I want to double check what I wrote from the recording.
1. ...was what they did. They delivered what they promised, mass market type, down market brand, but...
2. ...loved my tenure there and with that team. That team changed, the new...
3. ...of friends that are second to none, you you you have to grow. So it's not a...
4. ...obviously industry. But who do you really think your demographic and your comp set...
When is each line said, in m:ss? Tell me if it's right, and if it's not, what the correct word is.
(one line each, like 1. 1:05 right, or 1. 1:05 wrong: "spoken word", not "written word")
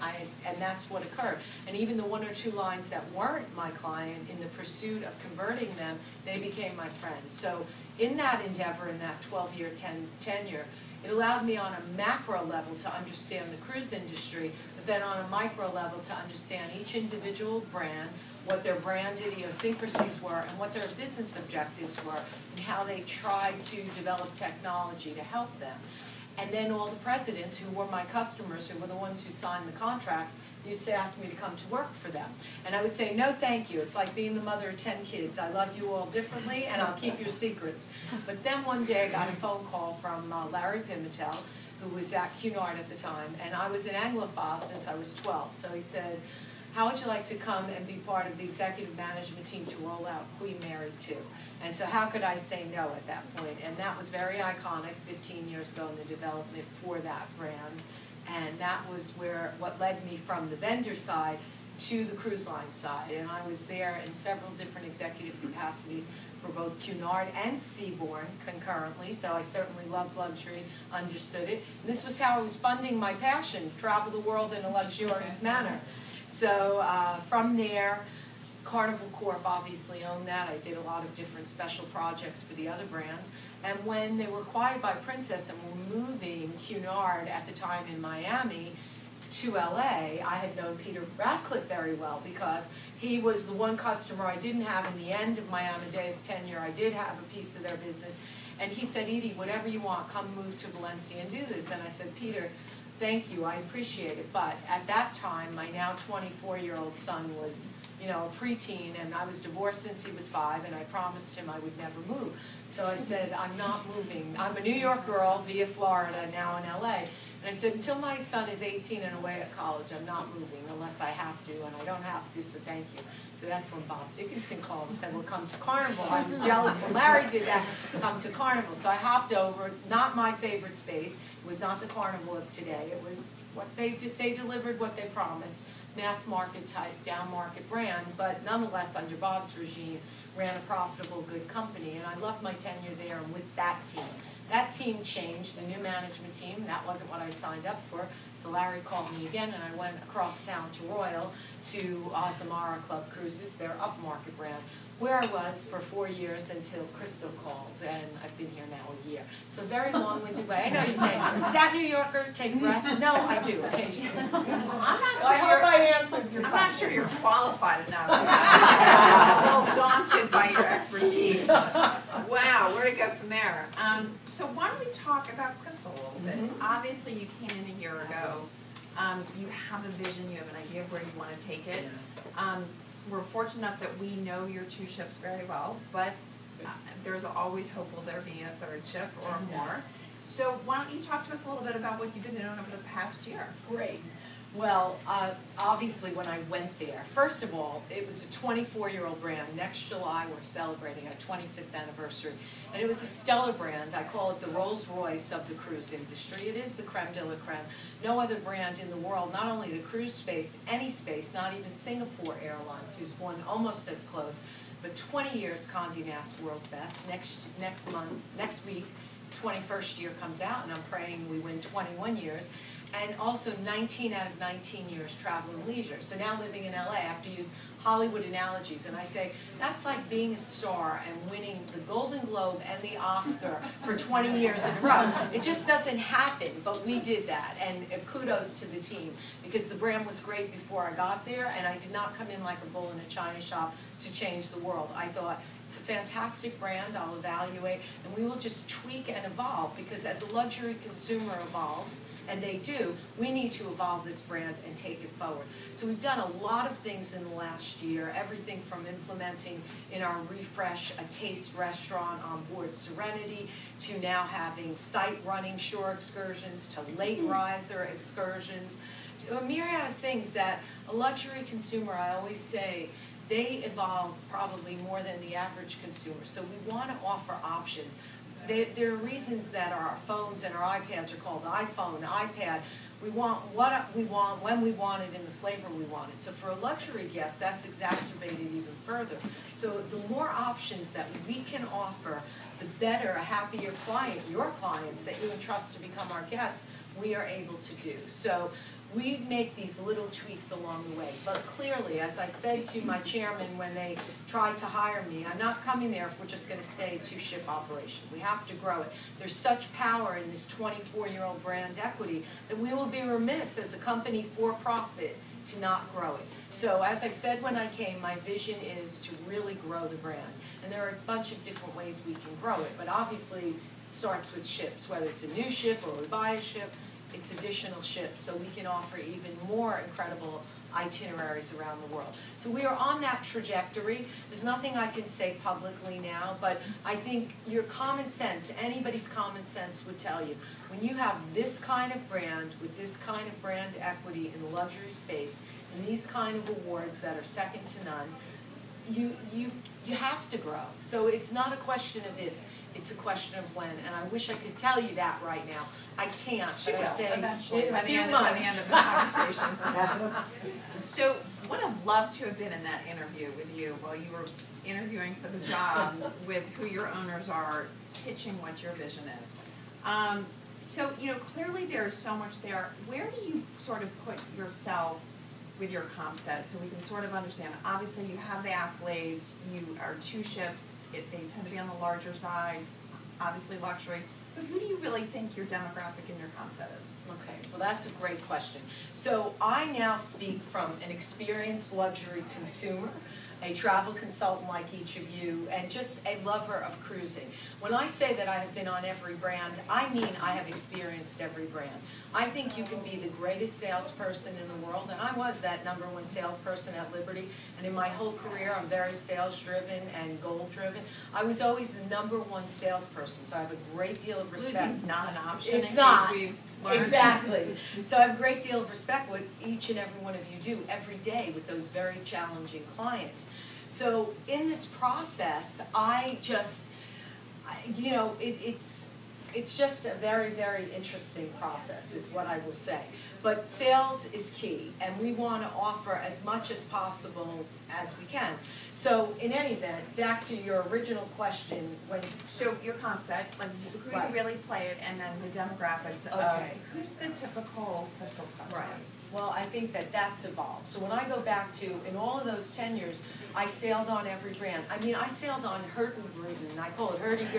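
1. 2:13 right
2. 2:22 right
3. 5:46 wrong: "awards", not "friends"
4. 6:23 wrong: "luxury", not "industry".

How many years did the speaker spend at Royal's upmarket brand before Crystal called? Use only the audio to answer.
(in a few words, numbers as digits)
4.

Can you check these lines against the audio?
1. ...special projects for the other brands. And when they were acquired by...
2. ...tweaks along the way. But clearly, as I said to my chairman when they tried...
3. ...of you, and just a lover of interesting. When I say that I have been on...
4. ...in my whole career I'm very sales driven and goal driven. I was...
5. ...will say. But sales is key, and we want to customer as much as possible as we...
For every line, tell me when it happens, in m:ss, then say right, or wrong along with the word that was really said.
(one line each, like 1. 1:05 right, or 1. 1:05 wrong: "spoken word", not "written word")
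1. 1:21 right
2. 5:00 right
3. 6:34 wrong: "cruising", not "interesting"
4. 6:47 right
5. 7:12 wrong: "offer", not "customer".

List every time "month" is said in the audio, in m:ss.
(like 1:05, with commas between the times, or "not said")
3:37, 5:58.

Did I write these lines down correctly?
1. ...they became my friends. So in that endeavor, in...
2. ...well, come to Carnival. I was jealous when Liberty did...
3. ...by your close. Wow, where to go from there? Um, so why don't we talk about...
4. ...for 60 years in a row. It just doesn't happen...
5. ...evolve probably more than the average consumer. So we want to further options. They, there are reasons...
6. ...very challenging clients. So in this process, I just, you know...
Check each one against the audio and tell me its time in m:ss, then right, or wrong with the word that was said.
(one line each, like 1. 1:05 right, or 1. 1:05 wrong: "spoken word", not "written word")
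1. 0:06 right
2. 2:05 wrong: "Larry", not "Liberty"
3. 2:50 wrong: "expertise", not "close"
4. 3:53 wrong: "20", not "60"
5. 4:33 wrong: "offer", not "further"
6. 7:01 right.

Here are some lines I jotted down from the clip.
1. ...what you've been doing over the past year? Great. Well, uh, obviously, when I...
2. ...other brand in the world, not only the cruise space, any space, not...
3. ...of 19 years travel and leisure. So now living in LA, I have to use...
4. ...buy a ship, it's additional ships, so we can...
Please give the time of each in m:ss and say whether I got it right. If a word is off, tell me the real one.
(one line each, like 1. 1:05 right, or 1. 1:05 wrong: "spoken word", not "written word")
1. 3:11 right
2. 3:28 right
3. 3:44 right
4. 5:26 right.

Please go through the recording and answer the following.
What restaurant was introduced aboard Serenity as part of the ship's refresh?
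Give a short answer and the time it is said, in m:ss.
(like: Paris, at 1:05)
Taste, at 4:20.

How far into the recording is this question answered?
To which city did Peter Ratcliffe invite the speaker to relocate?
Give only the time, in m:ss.
1:40.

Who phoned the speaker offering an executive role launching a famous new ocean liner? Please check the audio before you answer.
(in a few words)
Larry Pimentel.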